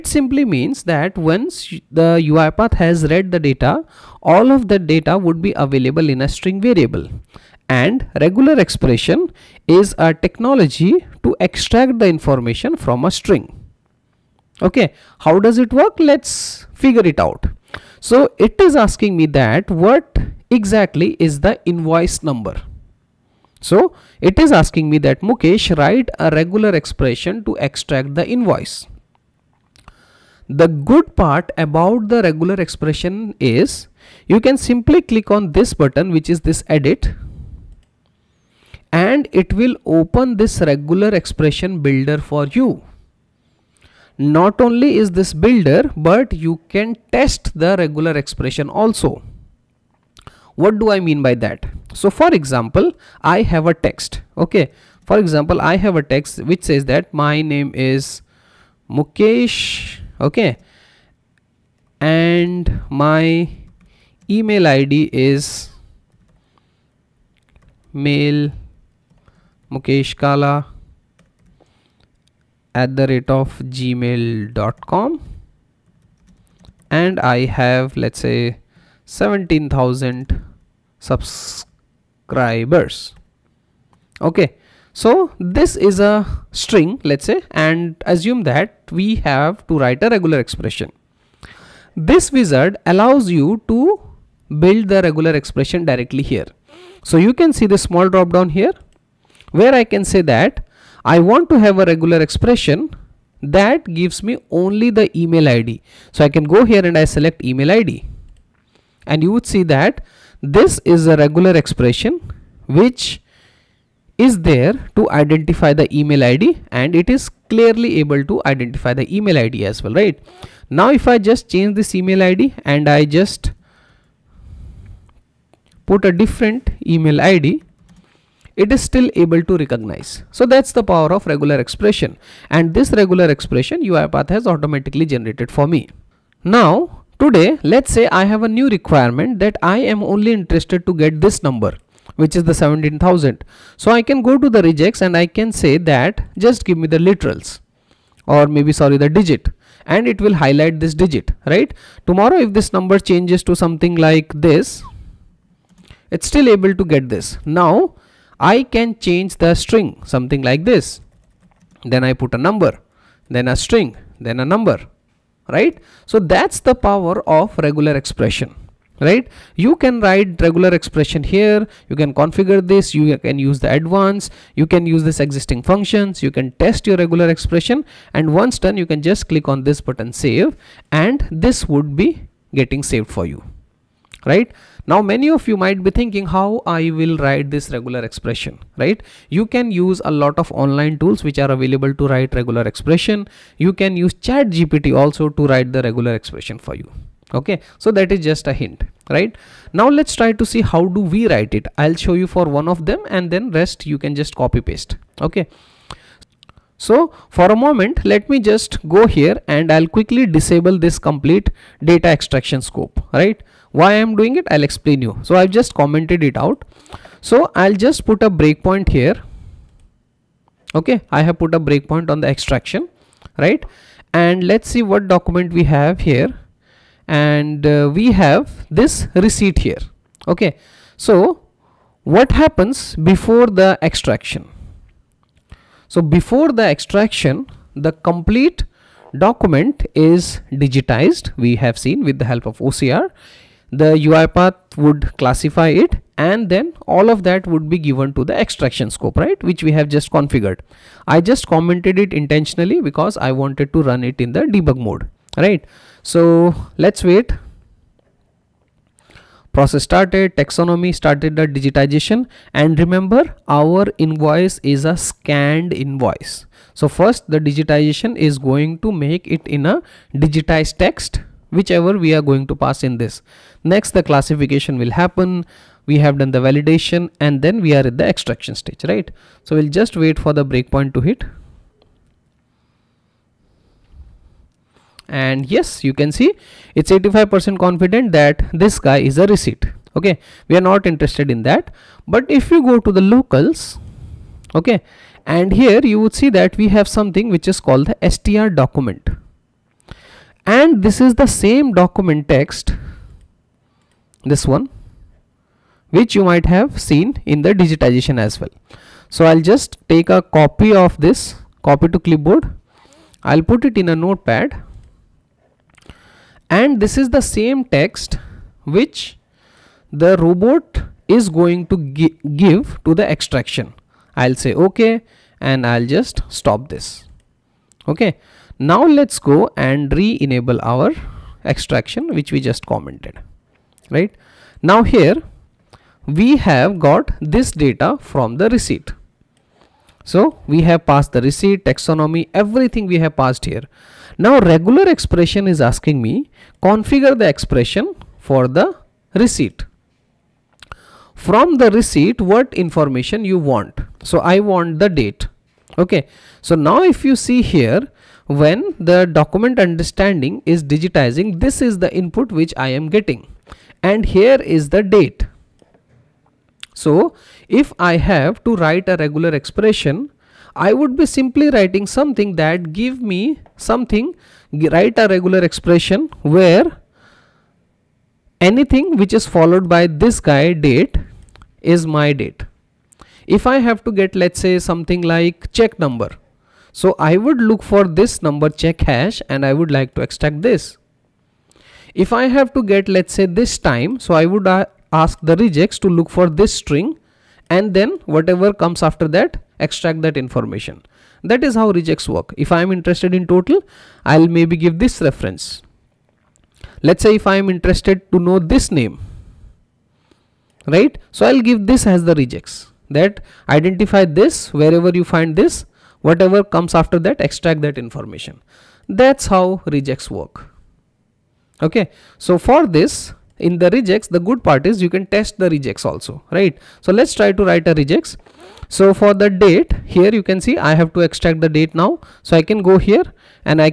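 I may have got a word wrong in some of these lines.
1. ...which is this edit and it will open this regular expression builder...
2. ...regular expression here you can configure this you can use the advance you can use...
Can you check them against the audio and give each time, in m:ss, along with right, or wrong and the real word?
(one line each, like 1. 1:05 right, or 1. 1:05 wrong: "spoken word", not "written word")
1. 0:36 right
2. 2:50 right.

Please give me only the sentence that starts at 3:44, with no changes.
And let's see what document we have here.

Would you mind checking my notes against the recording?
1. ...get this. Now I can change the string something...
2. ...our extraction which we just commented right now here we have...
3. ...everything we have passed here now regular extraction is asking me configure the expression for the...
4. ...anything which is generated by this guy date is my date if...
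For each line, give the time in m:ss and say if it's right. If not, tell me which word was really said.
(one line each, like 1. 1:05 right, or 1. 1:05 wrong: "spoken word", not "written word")
1. 2:36 right
2. 5:30 right
3. 5:42 wrong: "expression", not "extraction"
4. 6:18 wrong: "followed", not "generated".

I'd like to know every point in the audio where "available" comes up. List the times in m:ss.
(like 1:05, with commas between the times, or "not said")
0:05, 3:11.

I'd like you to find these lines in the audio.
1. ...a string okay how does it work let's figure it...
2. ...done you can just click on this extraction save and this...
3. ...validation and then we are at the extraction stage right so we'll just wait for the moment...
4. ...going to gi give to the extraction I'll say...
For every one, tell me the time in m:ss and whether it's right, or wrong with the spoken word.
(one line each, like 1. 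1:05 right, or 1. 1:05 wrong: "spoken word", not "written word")
1. 0:13 right
2. 2:58 wrong: "button", not "extraction"
3. 4:36 wrong: "breakpoint", not "moment"
4. 5:21 right.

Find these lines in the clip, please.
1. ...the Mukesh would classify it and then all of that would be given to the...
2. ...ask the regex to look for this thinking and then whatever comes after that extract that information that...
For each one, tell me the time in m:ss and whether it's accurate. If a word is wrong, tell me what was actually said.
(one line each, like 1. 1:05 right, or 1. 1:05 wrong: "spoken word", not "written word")
1. 4:03 wrong: "UiPath", not "Mukesh"
2. 6:34 wrong: "string", not "thinking".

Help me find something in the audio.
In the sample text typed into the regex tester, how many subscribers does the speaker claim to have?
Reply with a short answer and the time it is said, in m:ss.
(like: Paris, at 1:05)
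17,000, at 1:19.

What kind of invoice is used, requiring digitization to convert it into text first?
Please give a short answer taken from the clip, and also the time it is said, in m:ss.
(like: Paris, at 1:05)
scanned invoice, at 4:25.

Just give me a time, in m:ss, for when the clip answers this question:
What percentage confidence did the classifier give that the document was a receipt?
4:46.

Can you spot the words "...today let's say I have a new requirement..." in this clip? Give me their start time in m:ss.
2:17.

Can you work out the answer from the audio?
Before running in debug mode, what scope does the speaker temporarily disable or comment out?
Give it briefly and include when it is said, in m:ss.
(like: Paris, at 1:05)
data extraction scope, at 3:31.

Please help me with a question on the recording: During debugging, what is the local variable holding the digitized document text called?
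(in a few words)
str document.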